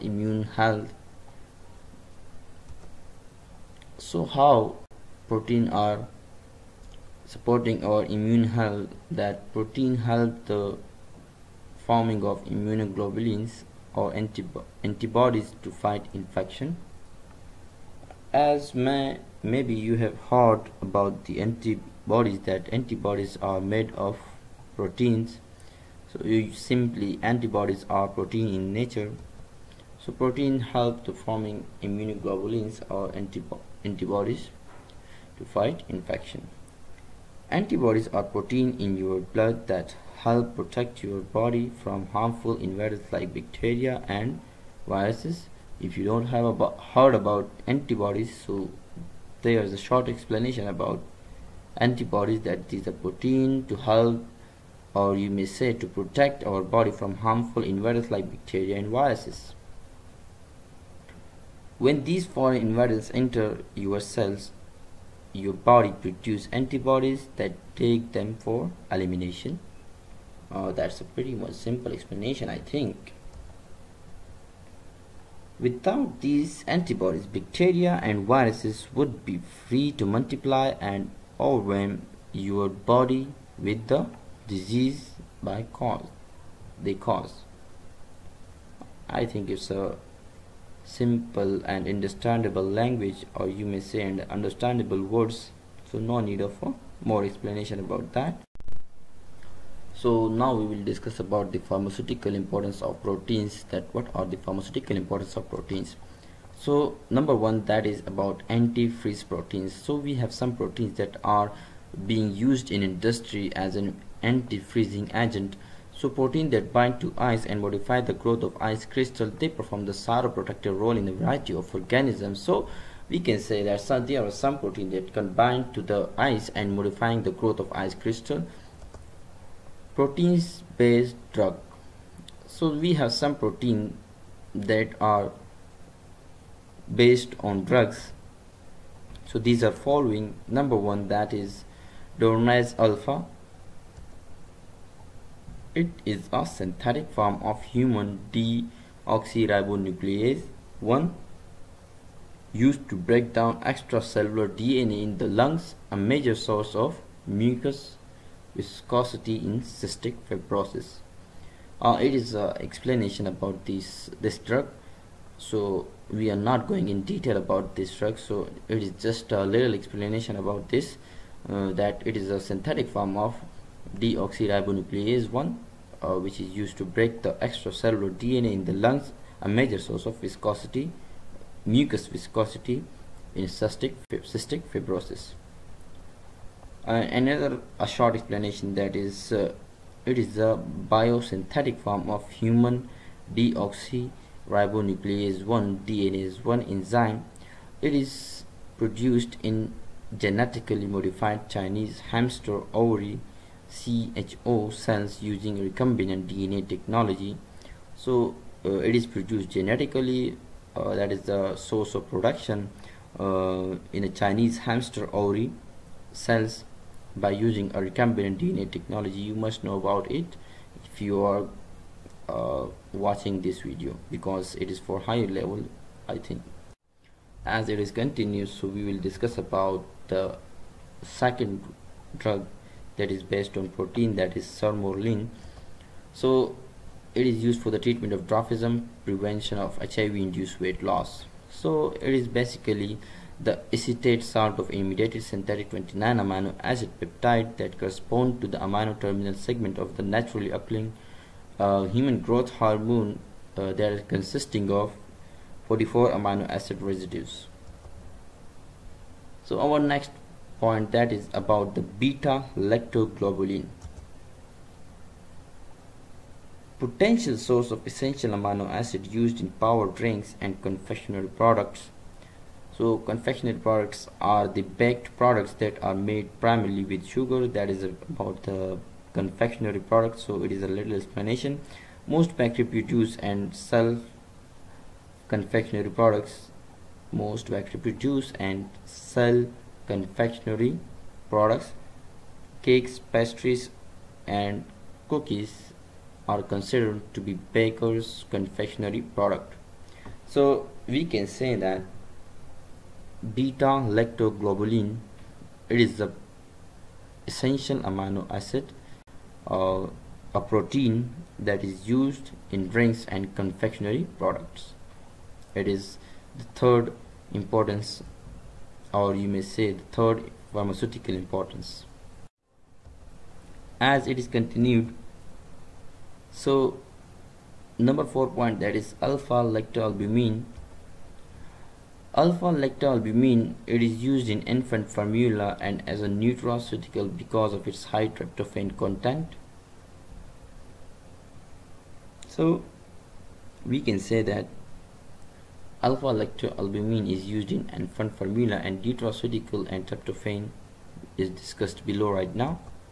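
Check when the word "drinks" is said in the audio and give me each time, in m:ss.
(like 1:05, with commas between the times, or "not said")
4:29, 5:12.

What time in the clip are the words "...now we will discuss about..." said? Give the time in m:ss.
1:40.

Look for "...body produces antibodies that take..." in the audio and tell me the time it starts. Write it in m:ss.
1:05.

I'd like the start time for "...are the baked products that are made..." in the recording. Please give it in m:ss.
4:34.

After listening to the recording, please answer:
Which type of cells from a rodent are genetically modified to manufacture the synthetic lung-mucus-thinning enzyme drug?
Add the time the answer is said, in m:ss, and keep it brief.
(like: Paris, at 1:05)
Chinese hamster ovary cells, at 3:21.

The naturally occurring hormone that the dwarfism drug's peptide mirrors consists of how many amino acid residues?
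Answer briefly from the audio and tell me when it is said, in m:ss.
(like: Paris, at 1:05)
44, at 4:15.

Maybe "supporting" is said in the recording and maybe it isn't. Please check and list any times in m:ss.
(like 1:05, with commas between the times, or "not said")
0:07.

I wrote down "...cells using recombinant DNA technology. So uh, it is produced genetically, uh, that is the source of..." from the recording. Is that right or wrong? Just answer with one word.
right.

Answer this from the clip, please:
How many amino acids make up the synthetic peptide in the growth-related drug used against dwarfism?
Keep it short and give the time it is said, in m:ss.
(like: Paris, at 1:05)
29, at 4:05.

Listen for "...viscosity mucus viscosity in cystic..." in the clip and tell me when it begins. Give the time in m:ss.
3:00.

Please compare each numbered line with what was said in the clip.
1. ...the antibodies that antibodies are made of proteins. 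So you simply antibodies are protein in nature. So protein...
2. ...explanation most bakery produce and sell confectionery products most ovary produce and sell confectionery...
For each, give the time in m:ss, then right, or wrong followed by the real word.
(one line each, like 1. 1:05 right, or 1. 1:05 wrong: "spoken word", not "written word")
1. 0:21 right
2. 4:40 wrong: "bakery", not "ovary".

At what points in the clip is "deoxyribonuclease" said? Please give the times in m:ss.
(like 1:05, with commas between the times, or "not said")
2:28, 2:53, 3:13.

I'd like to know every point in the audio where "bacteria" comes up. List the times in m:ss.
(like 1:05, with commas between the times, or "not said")
0:43, 0:58, 1:17.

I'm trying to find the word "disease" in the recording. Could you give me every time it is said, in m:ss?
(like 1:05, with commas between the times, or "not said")
1:24.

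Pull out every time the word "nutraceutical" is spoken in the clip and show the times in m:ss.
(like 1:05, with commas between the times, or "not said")
5:36, 5:48.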